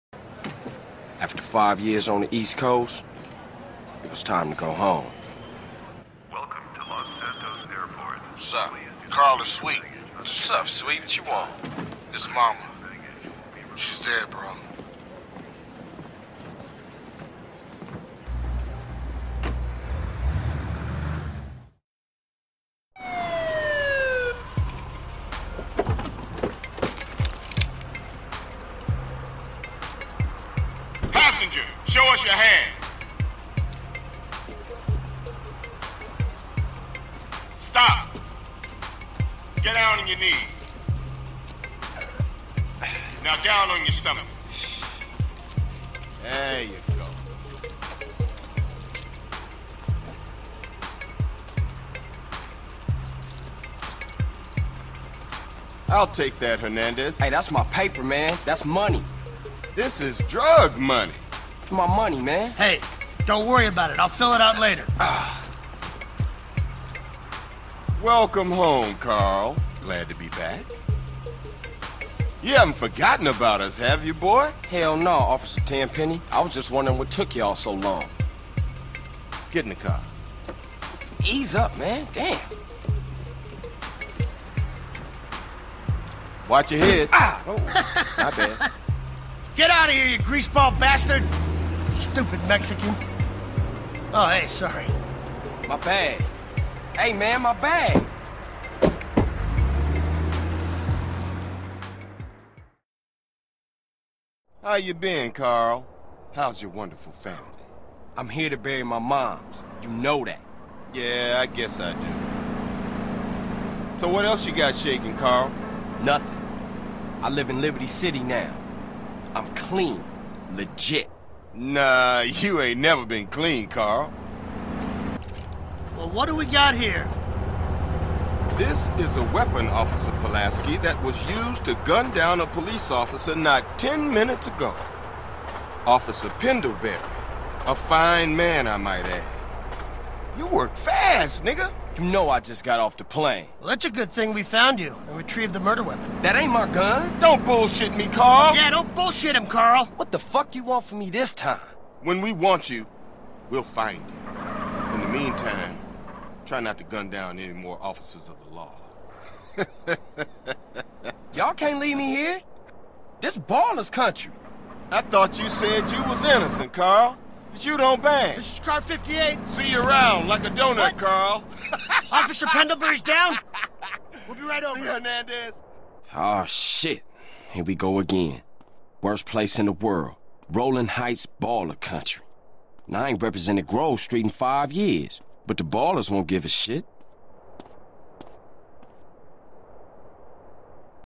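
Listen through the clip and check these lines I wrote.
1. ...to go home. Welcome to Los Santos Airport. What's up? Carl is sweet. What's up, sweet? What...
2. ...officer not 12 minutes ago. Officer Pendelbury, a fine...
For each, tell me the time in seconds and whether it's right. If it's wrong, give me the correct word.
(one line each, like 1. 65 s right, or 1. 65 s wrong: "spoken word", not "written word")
1. 4 s right
2. 132 s wrong: "10", not "12".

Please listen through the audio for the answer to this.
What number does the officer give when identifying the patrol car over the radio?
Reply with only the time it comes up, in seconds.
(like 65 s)
168 s.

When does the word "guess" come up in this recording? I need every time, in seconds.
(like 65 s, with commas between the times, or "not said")
111 s.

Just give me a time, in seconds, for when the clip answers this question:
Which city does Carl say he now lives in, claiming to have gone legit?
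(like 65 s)
117 s.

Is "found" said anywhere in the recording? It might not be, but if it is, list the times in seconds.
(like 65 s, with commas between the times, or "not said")
144 s.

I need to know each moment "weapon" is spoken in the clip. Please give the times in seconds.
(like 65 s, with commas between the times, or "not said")
129 s, 145 s.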